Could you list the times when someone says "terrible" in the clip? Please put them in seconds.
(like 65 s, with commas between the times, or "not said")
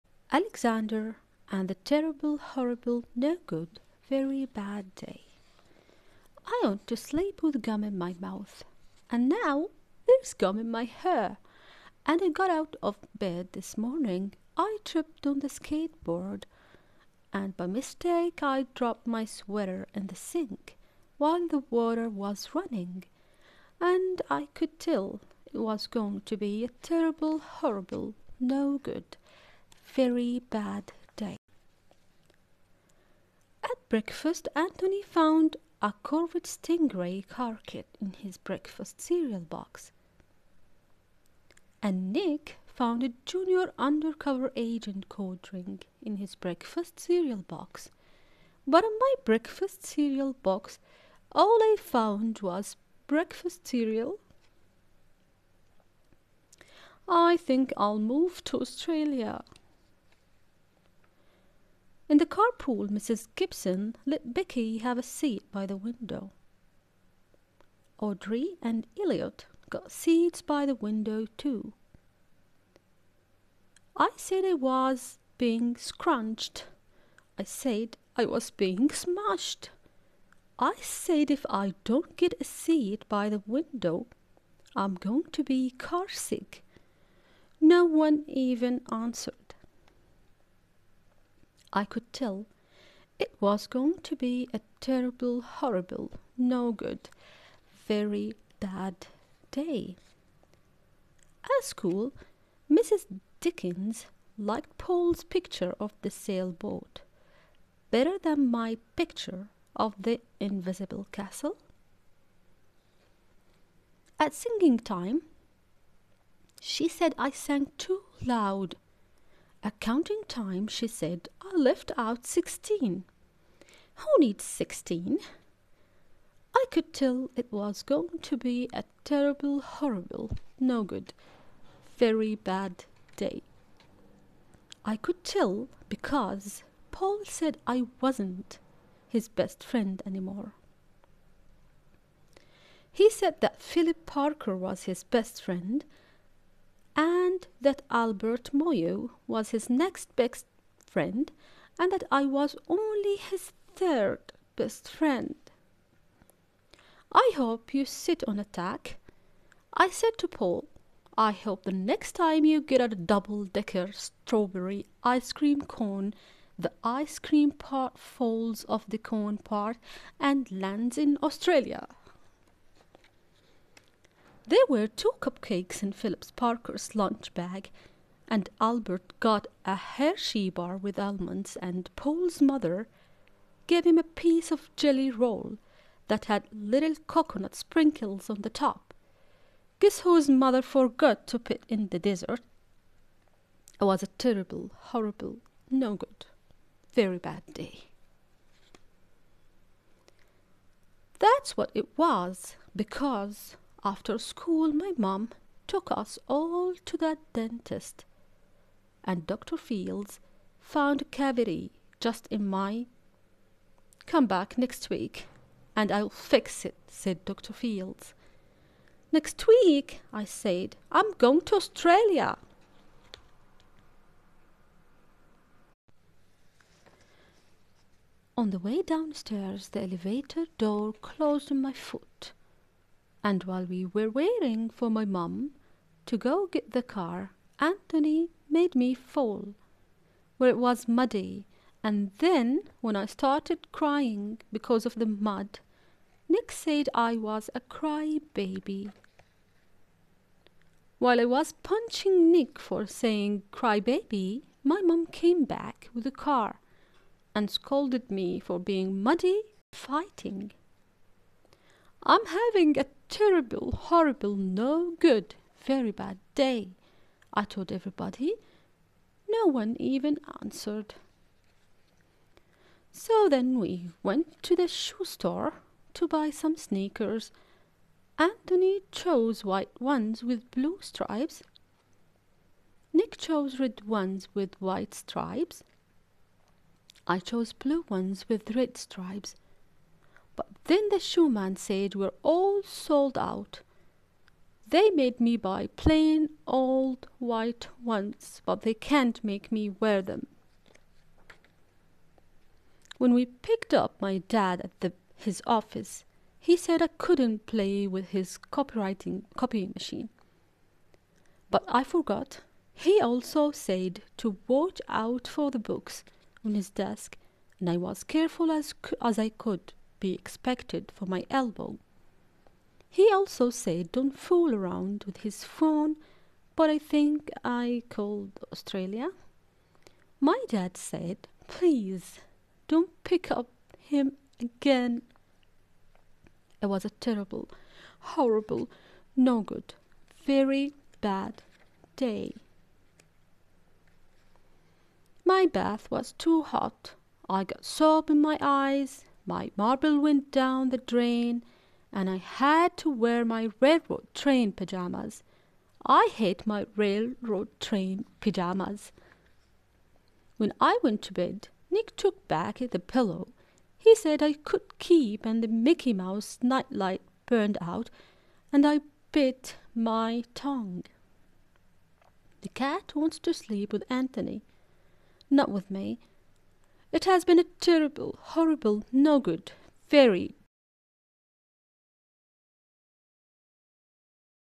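1 s, 26 s, 94 s, 129 s, 194 s, 263 s, 336 s, 377 s.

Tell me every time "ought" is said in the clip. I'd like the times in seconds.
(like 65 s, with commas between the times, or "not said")
6 s.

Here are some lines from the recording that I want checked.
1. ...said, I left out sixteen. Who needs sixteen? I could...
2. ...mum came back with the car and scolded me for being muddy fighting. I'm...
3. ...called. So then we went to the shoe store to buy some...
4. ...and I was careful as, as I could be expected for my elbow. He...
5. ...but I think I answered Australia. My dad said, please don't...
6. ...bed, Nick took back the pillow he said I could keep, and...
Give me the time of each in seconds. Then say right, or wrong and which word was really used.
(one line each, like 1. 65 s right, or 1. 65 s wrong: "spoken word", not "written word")
1. 120 s right
2. 254 s right
3. 270 s wrong: "answered", not "called"
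4. 317 s right
5. 326 s wrong: "called", not "answered"
6. 361 s right.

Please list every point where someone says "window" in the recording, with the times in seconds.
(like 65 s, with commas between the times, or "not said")
65 s, 70 s, 83 s.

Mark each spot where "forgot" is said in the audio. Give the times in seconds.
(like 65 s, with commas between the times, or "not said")
190 s, 311 s.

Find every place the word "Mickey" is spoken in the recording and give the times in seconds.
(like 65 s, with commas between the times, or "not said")
365 s.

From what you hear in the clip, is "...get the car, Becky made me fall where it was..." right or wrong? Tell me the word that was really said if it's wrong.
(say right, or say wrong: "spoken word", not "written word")
wrong: "Anthony", not "Becky".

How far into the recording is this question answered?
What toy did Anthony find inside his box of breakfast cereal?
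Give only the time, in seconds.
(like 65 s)
36 s.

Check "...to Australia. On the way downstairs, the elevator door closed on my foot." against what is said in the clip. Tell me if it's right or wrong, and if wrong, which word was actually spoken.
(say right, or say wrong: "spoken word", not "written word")
right.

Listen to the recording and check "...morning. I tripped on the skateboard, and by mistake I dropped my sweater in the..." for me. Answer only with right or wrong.
right.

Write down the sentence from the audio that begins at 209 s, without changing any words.
Fields found a cavity just in my.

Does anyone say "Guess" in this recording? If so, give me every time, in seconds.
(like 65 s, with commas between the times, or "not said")
189 s.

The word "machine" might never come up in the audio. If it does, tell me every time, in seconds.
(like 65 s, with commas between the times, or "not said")
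309 s.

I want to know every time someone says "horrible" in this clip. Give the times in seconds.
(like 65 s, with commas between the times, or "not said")
2 s, 27 s, 95 s, 129 s, 194 s, 263 s, 337 s, 378 s.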